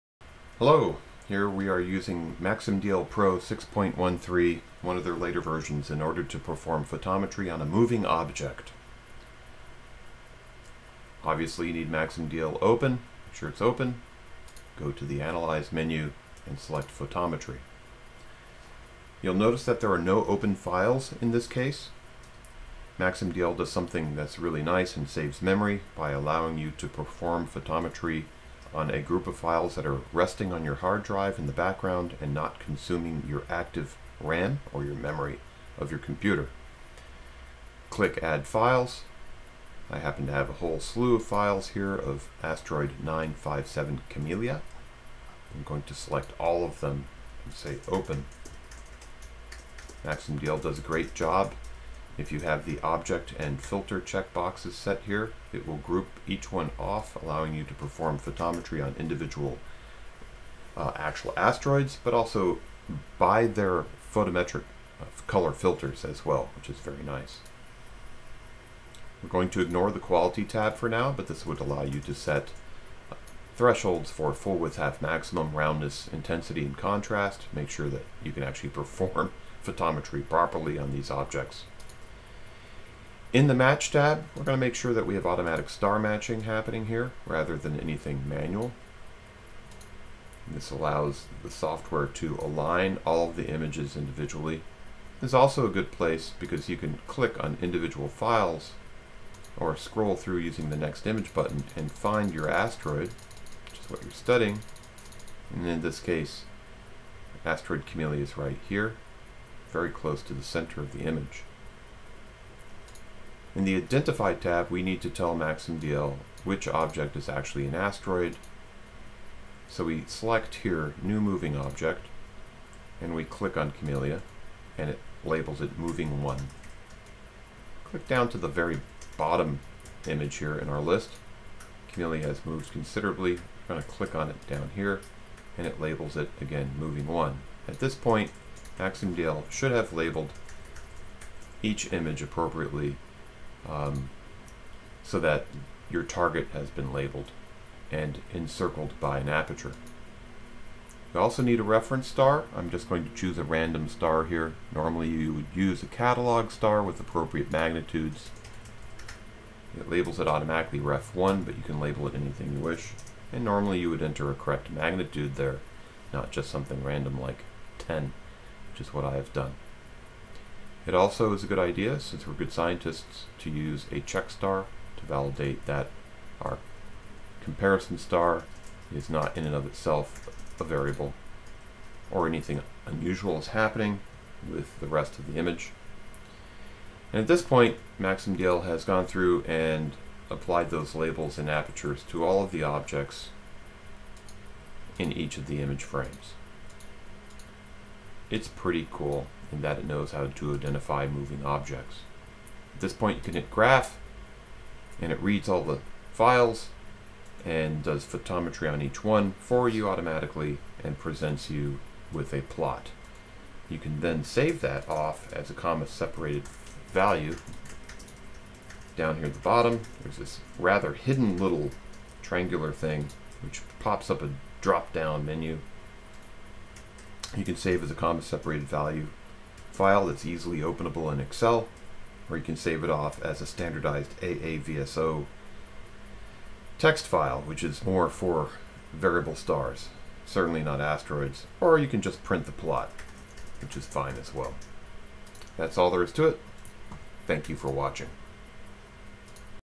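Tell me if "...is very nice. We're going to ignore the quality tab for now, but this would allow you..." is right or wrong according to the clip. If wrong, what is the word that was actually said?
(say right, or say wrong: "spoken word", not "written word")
right.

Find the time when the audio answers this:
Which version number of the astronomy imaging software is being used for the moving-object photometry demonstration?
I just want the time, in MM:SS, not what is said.
00:03.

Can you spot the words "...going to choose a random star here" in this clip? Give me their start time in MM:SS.
02:32.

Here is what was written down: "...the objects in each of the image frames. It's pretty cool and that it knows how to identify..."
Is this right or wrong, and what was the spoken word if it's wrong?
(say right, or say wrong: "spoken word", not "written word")
right.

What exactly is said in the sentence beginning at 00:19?
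You'll notice that there are no open files in this case.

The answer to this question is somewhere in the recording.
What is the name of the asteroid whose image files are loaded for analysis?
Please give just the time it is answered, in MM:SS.
00:43.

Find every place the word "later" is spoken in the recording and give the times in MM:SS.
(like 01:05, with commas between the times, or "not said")
00:05.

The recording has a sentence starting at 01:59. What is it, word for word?
So we select here, New Moving Object, and we click on Camelia, and it labels it Moving 1.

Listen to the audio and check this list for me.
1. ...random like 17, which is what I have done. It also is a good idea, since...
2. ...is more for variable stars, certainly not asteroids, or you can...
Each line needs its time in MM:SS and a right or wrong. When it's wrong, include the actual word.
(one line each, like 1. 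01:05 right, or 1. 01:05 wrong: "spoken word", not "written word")
1. 02:46 wrong: "10", not "17"
2. 03:57 right.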